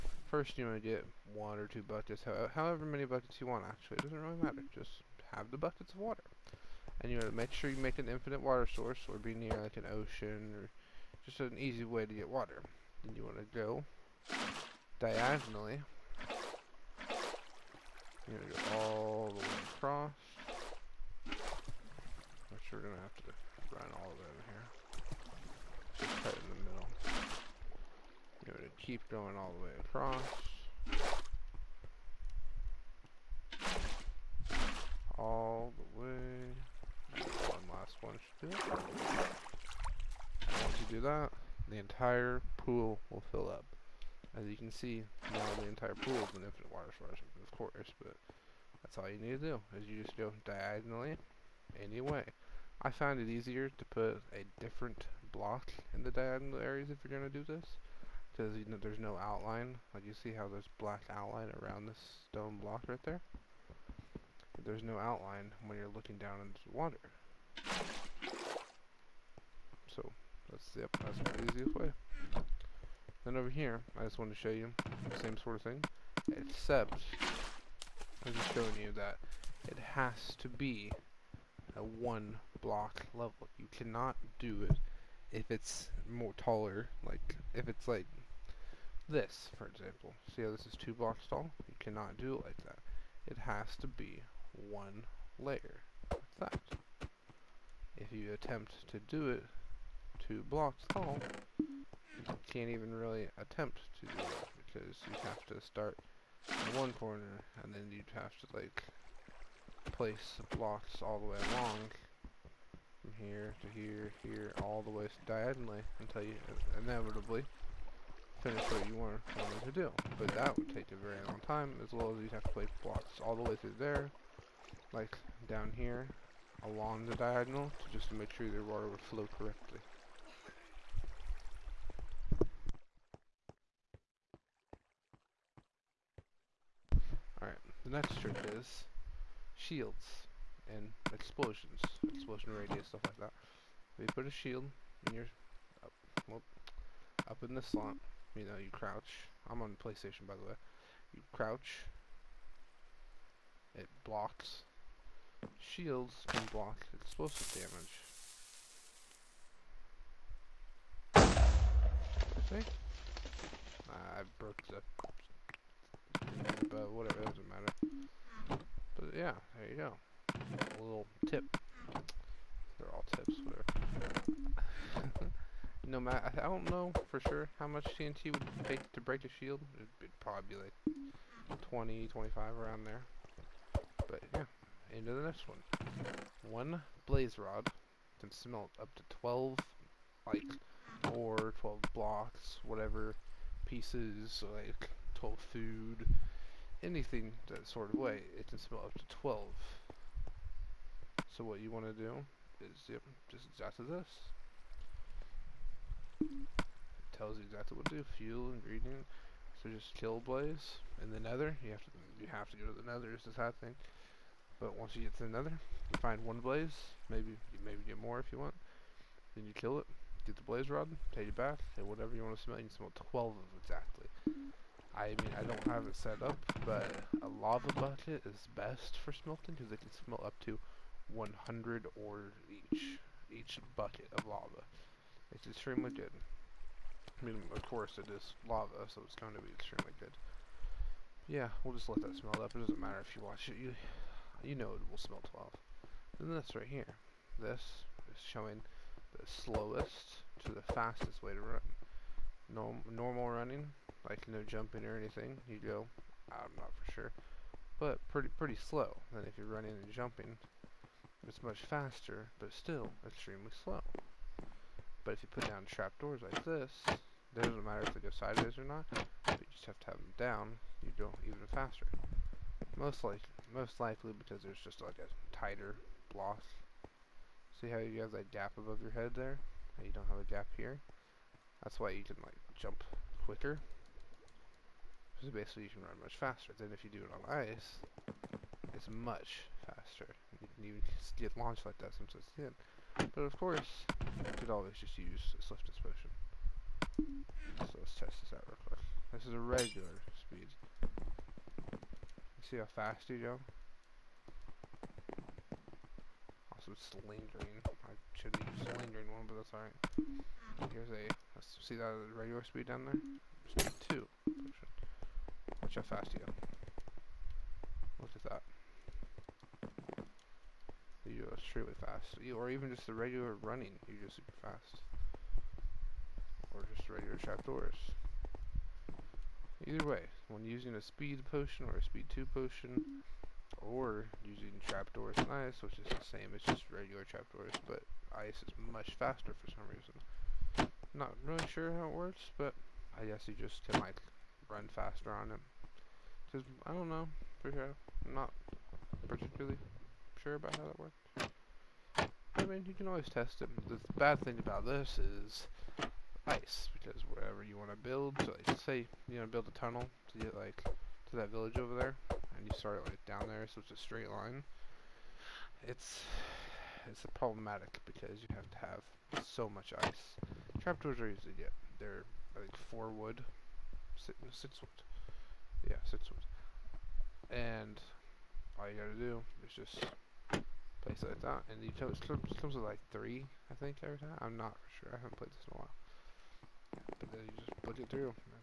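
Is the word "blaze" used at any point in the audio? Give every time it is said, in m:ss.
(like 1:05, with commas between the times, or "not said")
3:07, 3:30, 3:36, 3:40.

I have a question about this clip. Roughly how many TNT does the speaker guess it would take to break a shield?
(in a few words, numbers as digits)
20 to 25.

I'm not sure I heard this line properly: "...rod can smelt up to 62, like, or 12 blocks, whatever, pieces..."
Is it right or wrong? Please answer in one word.
wrong.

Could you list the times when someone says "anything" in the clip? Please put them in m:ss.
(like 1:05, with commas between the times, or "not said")
3:16, 4:14.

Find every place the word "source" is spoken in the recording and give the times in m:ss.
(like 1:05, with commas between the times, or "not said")
0:08, 0:46.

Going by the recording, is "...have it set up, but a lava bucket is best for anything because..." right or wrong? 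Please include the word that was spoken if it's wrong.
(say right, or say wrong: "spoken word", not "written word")
wrong: "smelting", not "anything".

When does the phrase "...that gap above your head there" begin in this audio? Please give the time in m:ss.
4:38.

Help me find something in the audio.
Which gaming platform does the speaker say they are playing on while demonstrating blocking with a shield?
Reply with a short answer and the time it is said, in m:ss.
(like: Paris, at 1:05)
PlayStation, at 2:29.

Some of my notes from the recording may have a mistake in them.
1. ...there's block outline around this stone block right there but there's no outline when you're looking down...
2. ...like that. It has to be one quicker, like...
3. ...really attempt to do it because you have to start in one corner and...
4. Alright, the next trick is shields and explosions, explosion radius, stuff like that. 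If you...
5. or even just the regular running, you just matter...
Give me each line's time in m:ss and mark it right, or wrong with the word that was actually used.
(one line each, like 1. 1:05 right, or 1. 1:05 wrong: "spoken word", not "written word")
1. 1:00 wrong: "black", not "block"
2. 1:32 wrong: "layer", not "quicker"
3. 1:42 right
4. 2:17 right
5. 5:22 wrong: "super", not "matter".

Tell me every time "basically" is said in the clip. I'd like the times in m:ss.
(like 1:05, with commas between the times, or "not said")
4:45.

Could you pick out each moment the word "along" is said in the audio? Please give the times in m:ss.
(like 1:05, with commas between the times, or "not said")
1:51, 2:06.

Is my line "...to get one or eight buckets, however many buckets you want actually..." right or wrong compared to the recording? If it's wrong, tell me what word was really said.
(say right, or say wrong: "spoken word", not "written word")
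wrong: "two", not "eight".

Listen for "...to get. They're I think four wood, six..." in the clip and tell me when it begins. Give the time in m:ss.
6:11.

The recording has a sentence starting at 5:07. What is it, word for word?
I should be used lingering one, but that's alright.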